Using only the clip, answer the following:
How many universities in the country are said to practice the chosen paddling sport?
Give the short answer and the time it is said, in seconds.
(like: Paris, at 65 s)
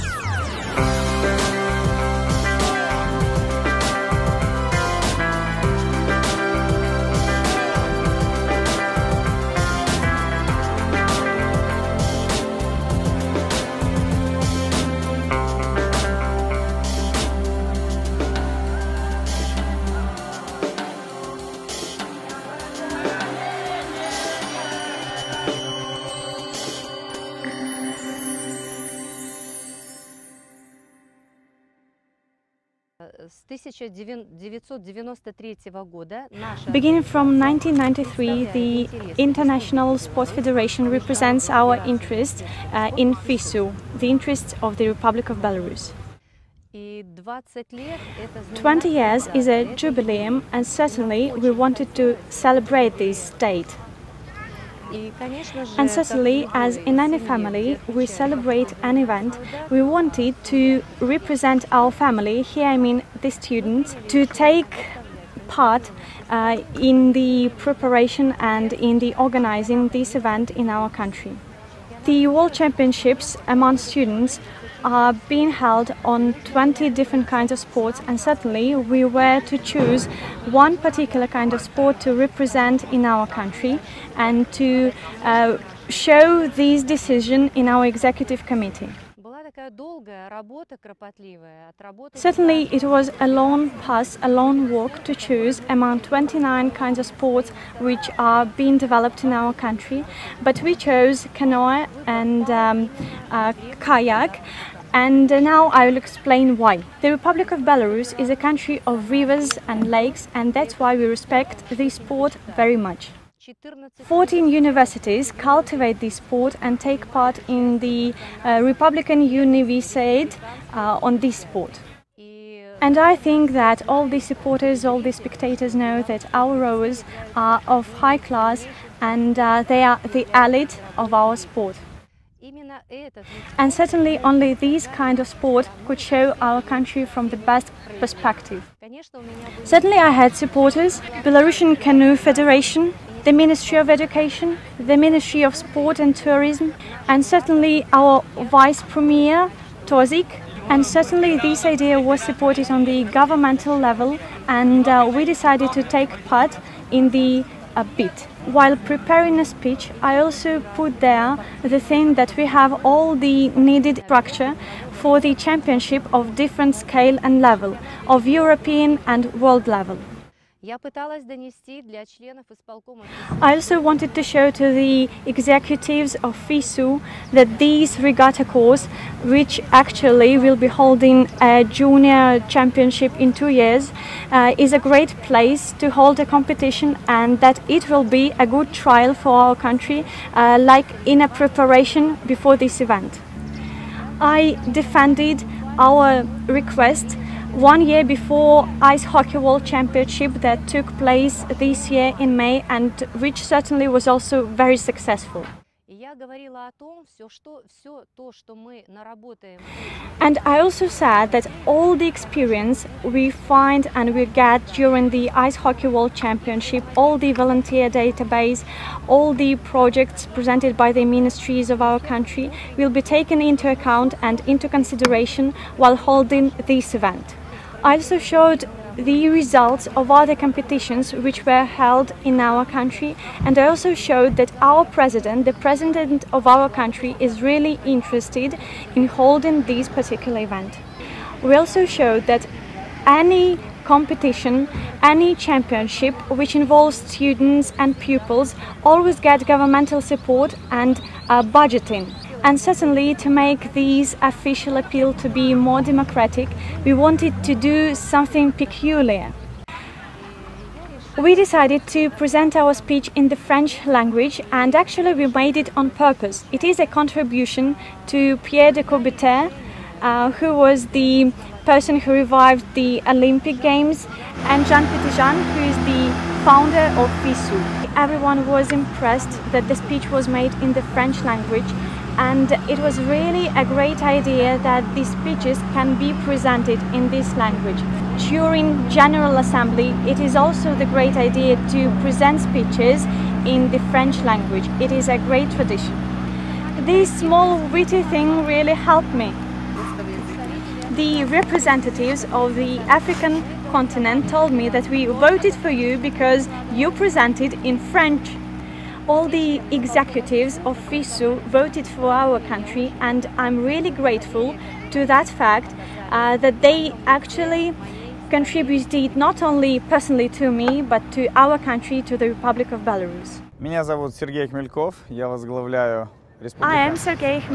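14, at 114 s.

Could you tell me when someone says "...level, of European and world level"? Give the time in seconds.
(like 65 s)
167 s.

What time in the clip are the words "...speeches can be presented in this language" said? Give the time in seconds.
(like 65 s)
285 s.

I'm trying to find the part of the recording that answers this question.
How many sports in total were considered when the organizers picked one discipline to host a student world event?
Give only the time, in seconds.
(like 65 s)
96 s.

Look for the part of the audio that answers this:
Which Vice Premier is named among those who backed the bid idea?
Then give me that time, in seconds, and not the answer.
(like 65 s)
149 s.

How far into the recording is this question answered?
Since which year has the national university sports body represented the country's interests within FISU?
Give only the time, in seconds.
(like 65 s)
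37 s.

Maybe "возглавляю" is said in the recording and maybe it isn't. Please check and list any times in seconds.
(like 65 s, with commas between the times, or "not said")
325 s.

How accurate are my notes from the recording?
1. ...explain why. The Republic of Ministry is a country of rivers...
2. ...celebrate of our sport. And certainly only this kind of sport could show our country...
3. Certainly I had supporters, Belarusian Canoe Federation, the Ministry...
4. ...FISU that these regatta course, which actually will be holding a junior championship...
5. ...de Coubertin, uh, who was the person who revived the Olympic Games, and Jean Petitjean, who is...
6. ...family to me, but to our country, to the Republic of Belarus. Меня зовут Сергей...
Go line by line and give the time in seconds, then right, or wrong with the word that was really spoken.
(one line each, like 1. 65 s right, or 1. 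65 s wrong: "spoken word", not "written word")
1. 105 s wrong: "Belarus", not "Ministry"
2. 130 s wrong: "elite", not "celebrate"
3. 139 s right
4. 176 s right
5. 268 s right
6. 319 s wrong: "personally", not "family".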